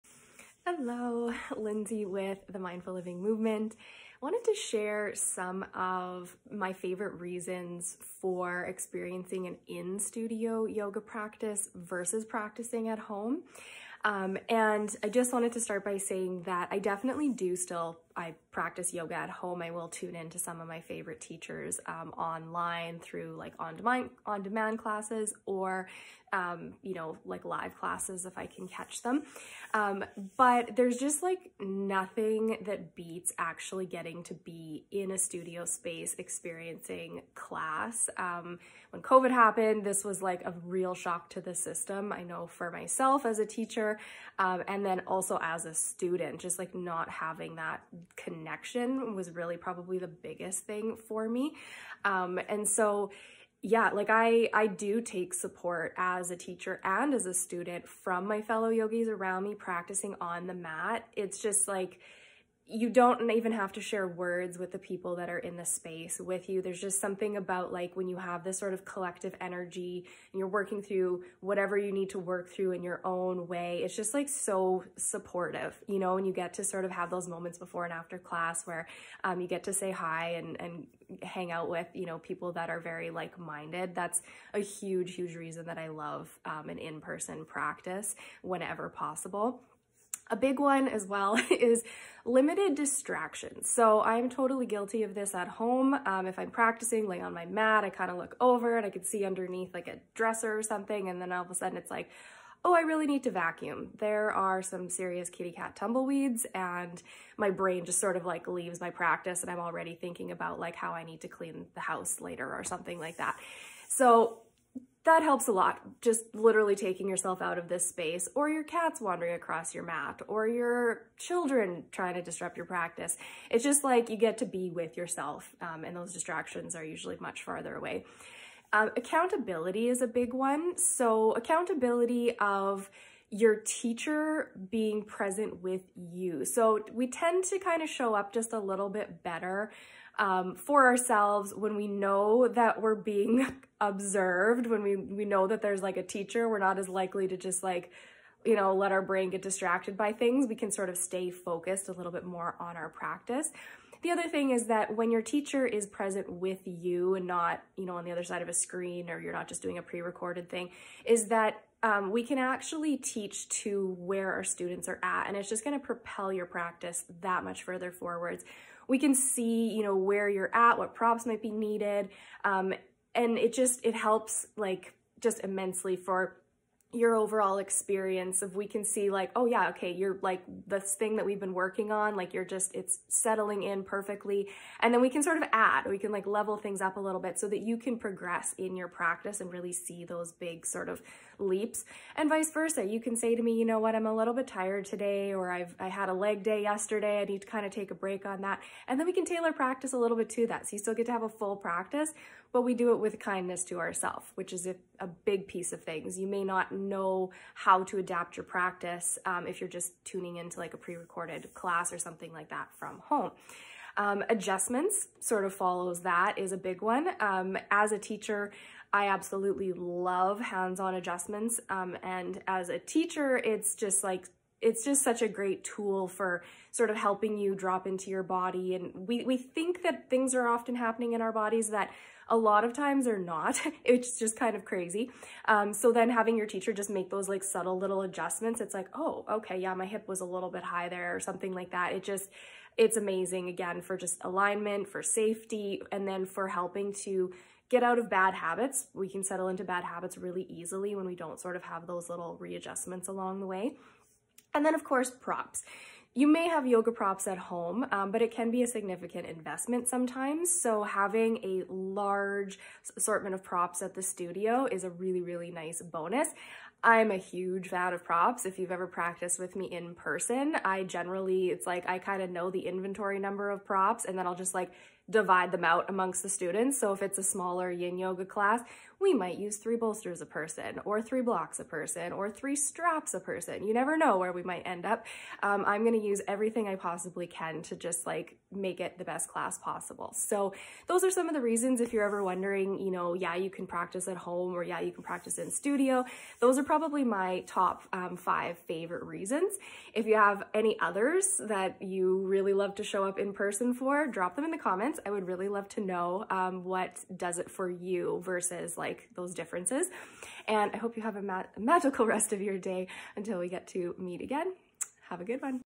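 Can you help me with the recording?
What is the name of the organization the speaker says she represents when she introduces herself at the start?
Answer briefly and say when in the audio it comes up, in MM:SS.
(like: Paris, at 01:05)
Mindful Living Movement, at 00:02.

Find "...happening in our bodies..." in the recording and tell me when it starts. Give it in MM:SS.
03:50.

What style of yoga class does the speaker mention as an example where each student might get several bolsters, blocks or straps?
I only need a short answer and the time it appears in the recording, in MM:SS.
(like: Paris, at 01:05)
yin yoga, at 04:37.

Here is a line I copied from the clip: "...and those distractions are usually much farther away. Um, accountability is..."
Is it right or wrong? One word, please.
right.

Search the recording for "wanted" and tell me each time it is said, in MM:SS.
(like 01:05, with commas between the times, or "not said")
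00:04, 00:15.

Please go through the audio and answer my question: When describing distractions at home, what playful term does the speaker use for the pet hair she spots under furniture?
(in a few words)
kitty cat tumbleweeds.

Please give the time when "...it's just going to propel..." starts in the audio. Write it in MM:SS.
02:45.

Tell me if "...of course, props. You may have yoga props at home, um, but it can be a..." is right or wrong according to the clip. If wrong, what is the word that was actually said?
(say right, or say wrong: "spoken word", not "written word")
right.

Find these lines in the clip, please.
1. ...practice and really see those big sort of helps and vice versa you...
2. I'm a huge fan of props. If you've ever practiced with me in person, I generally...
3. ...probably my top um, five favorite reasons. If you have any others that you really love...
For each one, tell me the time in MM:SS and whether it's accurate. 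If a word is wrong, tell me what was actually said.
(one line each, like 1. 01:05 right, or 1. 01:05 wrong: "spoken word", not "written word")
1. 03:08 wrong: "leaps", not "helps"
2. 04:26 right
3. 04:56 right.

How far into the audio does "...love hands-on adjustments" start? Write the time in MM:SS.
03:39.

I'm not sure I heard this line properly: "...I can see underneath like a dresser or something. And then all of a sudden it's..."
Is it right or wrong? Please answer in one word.
right.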